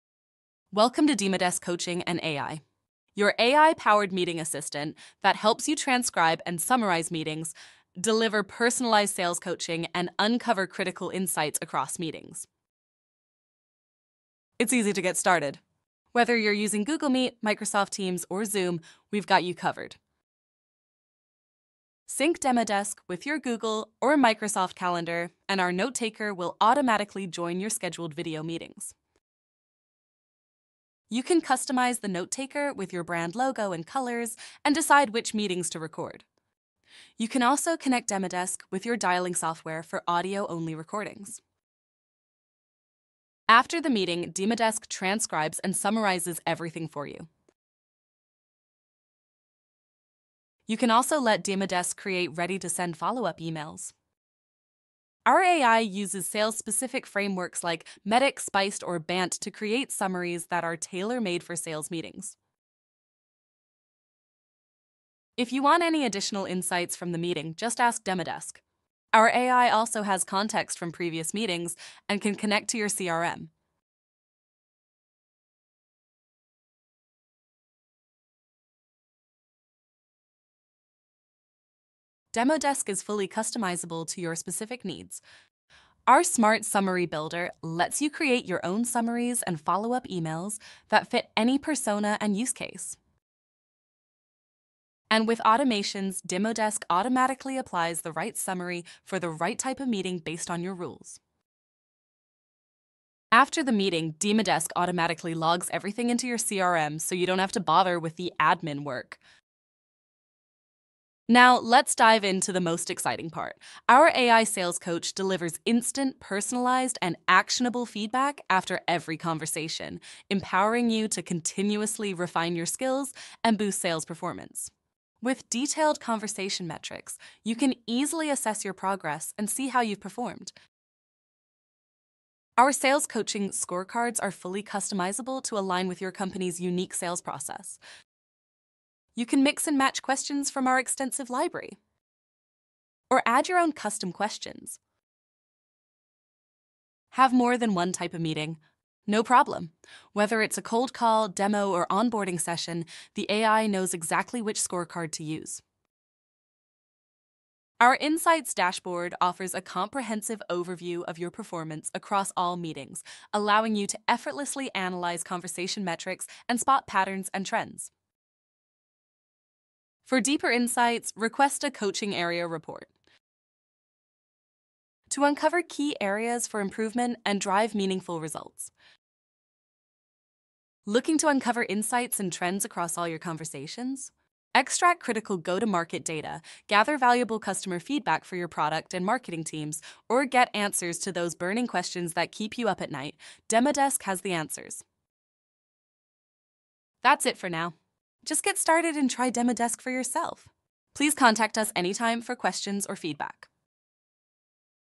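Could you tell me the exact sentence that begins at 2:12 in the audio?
Our sales coaching scorecards are fully customizable to align with your company's unique sales process.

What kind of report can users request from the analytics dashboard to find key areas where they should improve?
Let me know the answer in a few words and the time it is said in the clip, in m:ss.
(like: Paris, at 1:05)
coaching area report, at 2:51.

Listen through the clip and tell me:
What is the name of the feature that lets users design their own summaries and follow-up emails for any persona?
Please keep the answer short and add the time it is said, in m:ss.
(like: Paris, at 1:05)
Smart Summary Builder, at 1:26.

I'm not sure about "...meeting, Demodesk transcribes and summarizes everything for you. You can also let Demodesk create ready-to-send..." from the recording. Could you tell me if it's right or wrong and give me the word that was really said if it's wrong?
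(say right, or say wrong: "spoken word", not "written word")
right.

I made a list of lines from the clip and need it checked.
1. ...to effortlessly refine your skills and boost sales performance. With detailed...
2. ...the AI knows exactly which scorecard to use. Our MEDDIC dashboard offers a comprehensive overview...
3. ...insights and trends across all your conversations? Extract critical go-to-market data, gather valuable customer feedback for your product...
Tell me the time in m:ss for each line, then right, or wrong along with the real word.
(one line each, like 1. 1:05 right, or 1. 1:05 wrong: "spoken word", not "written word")
1. 2:01 wrong: "continuously", not "effortlessly"
2. 2:33 wrong: "Insights", not "MEDDIC"
3. 3:01 right.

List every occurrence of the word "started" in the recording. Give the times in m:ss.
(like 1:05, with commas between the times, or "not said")
0:15, 3:18.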